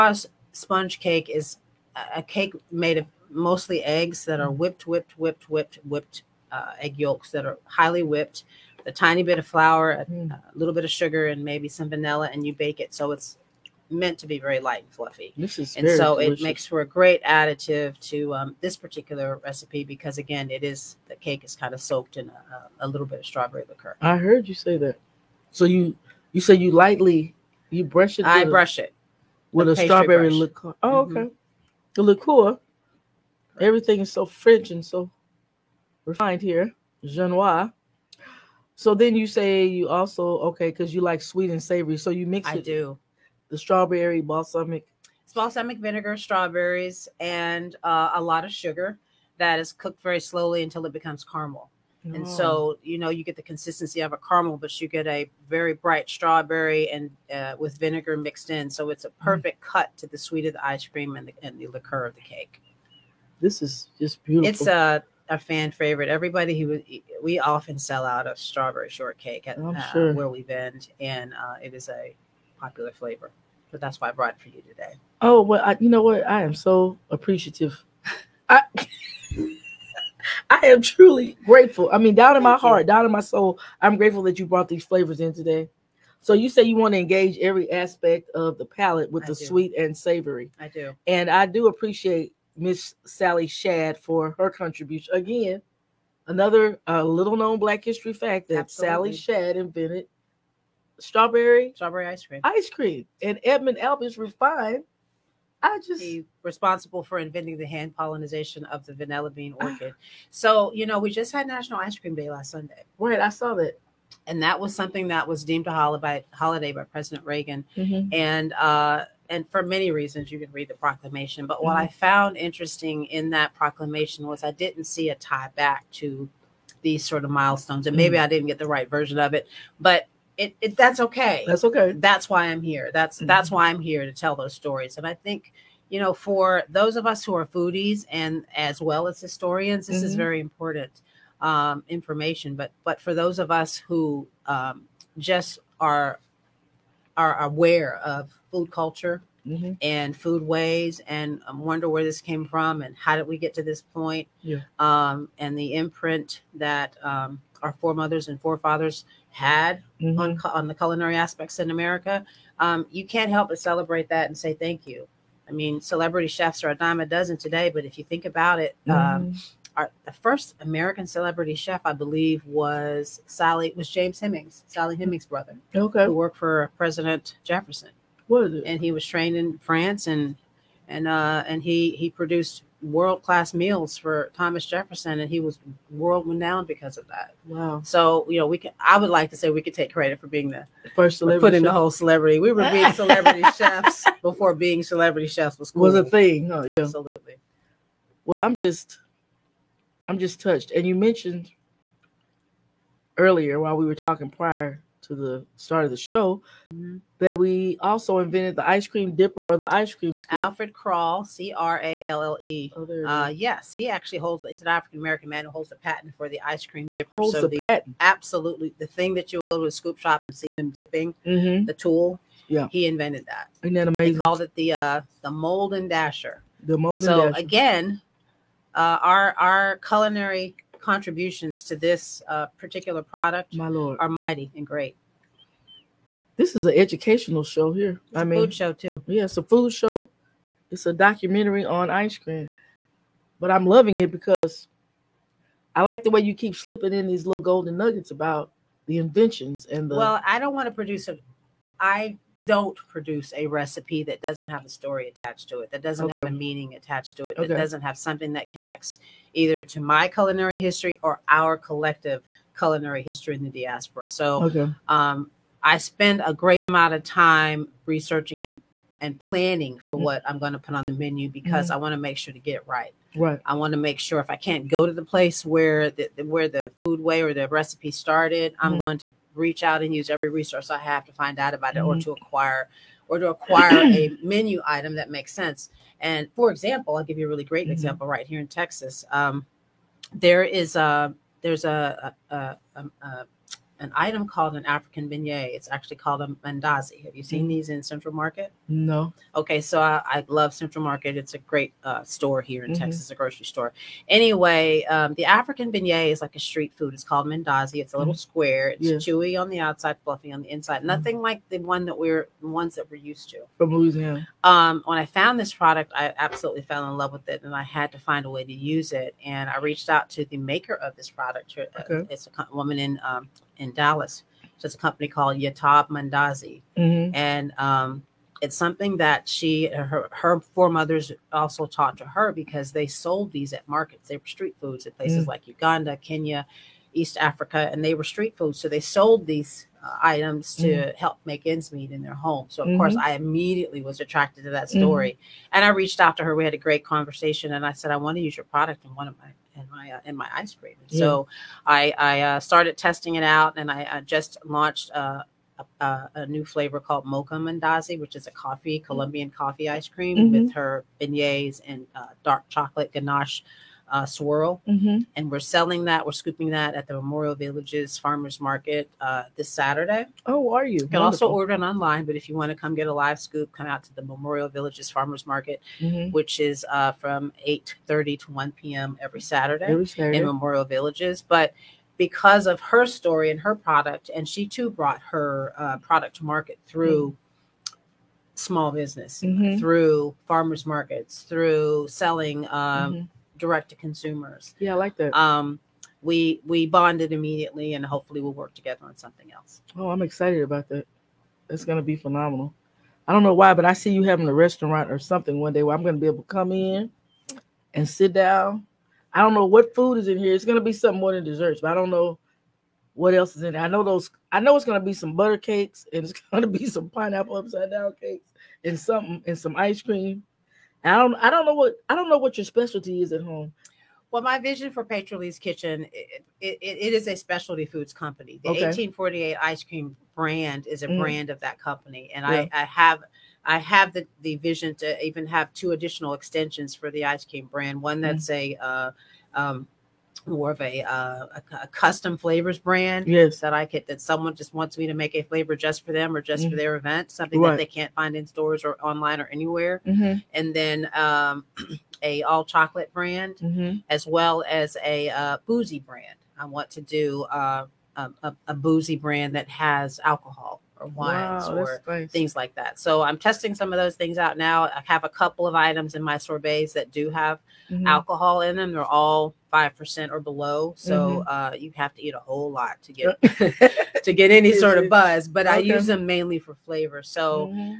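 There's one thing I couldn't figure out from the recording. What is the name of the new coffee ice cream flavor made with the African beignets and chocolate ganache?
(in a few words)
Mocha Mandazi.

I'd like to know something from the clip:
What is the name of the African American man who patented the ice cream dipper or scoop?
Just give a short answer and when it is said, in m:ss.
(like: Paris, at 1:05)
Alfred Cralle, at 3:30.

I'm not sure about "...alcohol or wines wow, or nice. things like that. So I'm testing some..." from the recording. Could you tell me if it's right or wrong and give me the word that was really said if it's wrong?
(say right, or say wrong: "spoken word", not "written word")
right.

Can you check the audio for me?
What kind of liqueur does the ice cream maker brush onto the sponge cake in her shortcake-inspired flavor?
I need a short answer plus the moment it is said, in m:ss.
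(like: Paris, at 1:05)
Strawberry liqueur, at 0:23.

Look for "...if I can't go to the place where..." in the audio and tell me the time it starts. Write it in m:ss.
4:34.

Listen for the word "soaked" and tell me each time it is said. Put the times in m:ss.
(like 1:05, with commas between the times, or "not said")
0:21.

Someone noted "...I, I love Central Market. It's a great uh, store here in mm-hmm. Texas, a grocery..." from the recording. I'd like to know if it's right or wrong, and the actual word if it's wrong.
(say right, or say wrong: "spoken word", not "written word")
right.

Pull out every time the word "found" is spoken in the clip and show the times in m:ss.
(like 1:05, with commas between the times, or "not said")
2:01, 5:15.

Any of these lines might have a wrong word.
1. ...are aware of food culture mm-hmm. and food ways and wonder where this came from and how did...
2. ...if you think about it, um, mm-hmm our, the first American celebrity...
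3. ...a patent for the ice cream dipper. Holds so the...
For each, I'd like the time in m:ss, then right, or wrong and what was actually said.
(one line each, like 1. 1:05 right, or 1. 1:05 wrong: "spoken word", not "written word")
1. 2:27 right
2. 2:47 right
3. 3:35 right.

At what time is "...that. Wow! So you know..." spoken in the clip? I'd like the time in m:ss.
3:07.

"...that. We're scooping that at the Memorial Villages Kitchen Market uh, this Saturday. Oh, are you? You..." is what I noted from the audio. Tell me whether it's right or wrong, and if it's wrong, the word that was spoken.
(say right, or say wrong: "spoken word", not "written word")
wrong: "Farmers", not "Kitchen".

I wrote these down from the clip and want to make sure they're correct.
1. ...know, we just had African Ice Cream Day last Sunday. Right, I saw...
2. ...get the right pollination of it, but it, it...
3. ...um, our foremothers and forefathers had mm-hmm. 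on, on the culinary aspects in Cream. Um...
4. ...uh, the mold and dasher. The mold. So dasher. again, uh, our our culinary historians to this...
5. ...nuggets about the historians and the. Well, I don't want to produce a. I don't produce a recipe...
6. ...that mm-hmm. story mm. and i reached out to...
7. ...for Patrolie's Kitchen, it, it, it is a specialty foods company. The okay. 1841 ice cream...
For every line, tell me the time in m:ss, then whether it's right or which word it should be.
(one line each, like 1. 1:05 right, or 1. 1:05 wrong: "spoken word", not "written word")
1. 1:50 wrong: "National", not "African"
2. 2:08 wrong: "version", not "pollination"
3. 2:37 wrong: "America", not "Cream"
4. 3:44 wrong: "contributions", not "historians"
5. 4:07 wrong: "inventions", not "historians"
6. 5:44 right
7. 7:04 wrong: "1848", not "1841".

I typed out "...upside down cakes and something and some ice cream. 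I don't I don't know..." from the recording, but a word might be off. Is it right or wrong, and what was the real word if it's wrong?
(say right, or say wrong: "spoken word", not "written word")
right.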